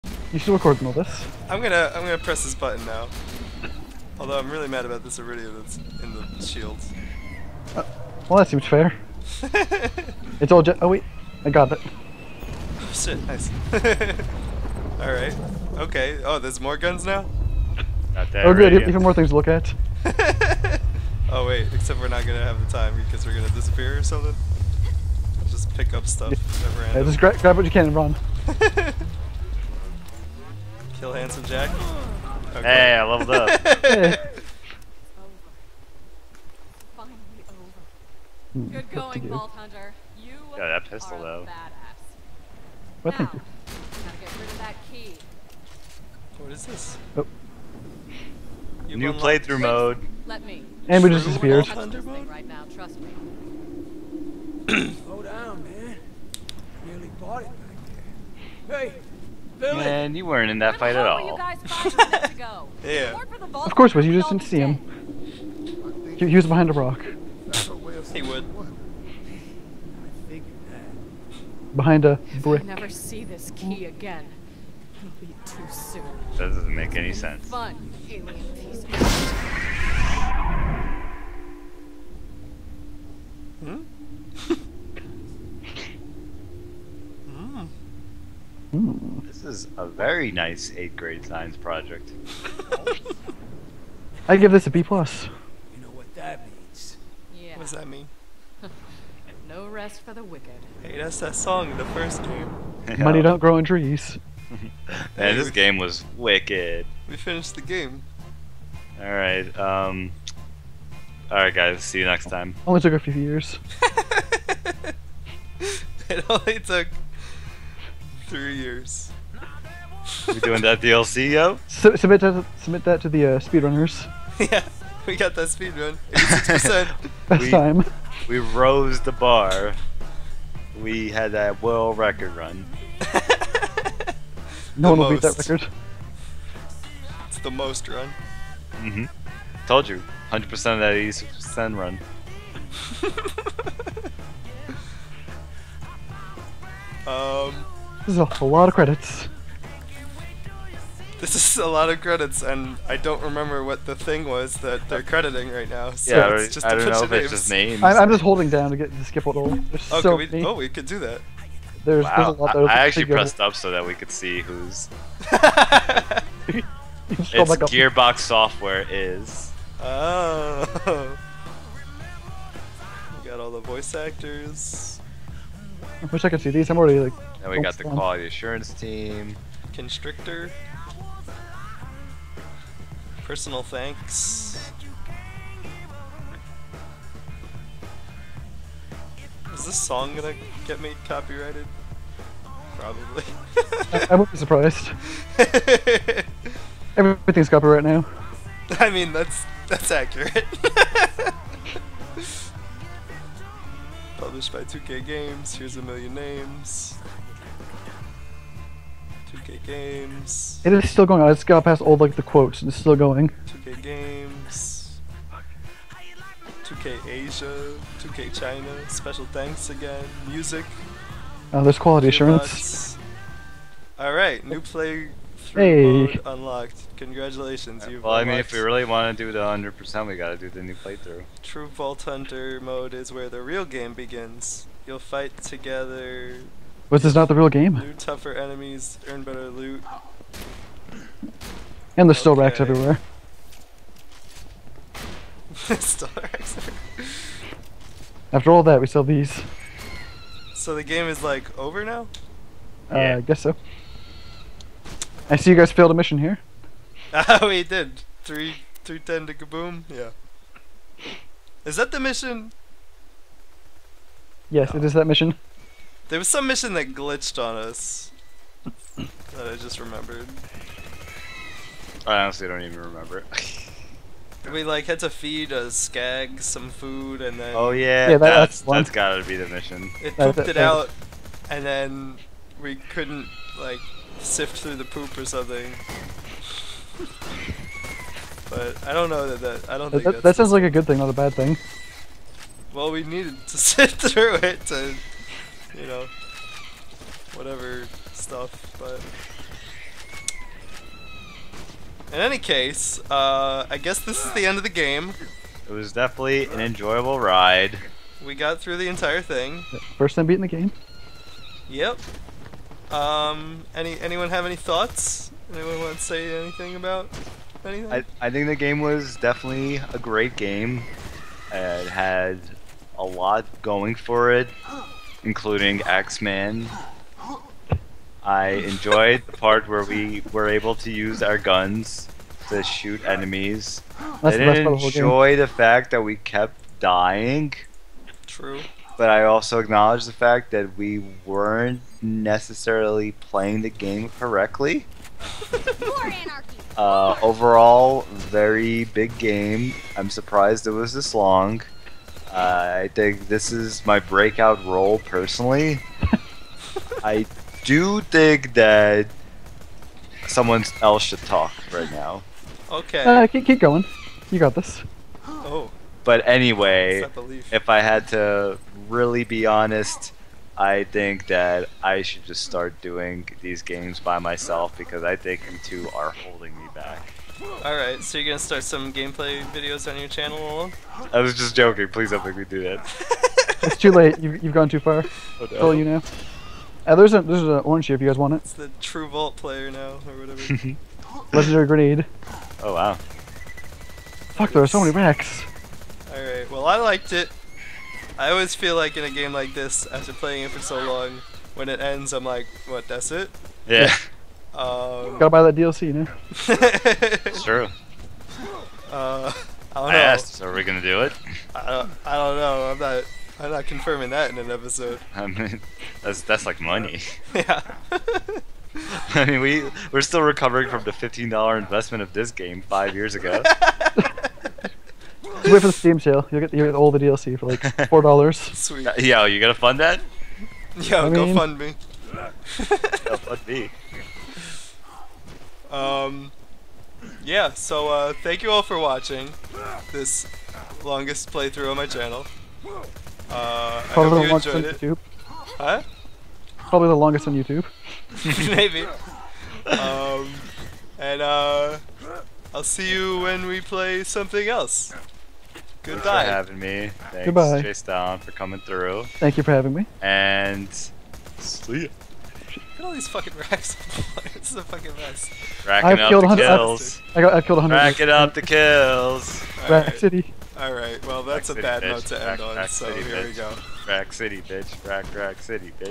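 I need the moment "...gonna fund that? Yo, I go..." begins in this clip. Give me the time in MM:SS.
07:09.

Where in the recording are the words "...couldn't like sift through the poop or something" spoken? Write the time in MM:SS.
04:42.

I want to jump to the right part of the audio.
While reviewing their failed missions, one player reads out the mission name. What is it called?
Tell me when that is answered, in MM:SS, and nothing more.
04:18.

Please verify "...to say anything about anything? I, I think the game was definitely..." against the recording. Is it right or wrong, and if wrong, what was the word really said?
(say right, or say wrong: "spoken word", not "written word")
right.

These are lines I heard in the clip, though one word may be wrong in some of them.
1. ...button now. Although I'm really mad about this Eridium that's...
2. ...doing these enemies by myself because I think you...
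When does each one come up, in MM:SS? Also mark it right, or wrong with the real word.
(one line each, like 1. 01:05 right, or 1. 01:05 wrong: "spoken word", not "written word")
1. 00:02 right
2. 06:12 wrong: "games", not "enemies".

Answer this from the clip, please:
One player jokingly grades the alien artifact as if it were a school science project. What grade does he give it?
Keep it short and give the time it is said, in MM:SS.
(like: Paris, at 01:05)
B plus, at 01:34.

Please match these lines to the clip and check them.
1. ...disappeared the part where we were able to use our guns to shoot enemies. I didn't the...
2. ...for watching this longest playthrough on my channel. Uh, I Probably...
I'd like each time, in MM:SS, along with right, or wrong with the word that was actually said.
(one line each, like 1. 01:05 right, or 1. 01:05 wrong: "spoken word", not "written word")
1. 05:28 wrong: "enjoyed", not "disappeared"
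2. 07:18 right.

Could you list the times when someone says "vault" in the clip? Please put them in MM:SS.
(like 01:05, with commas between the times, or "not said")
00:39, 03:51, 06:29.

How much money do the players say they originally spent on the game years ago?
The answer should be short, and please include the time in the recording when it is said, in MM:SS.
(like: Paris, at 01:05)
$15, at 07:00.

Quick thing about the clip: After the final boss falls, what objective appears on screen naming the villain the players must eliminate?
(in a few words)
Kill Handsome Jack.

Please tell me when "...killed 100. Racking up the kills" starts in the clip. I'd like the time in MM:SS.
07:47.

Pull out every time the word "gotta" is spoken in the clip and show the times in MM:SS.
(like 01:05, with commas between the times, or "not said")
00:43, 03:50, 04:38, 06:45.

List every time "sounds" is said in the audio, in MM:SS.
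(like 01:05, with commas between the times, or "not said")
04:50.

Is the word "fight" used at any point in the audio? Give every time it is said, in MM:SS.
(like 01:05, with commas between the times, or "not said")
01:00, 03:54.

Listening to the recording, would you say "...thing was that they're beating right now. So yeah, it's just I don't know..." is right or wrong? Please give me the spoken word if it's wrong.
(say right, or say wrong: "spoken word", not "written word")
wrong: "crediting", not "beating".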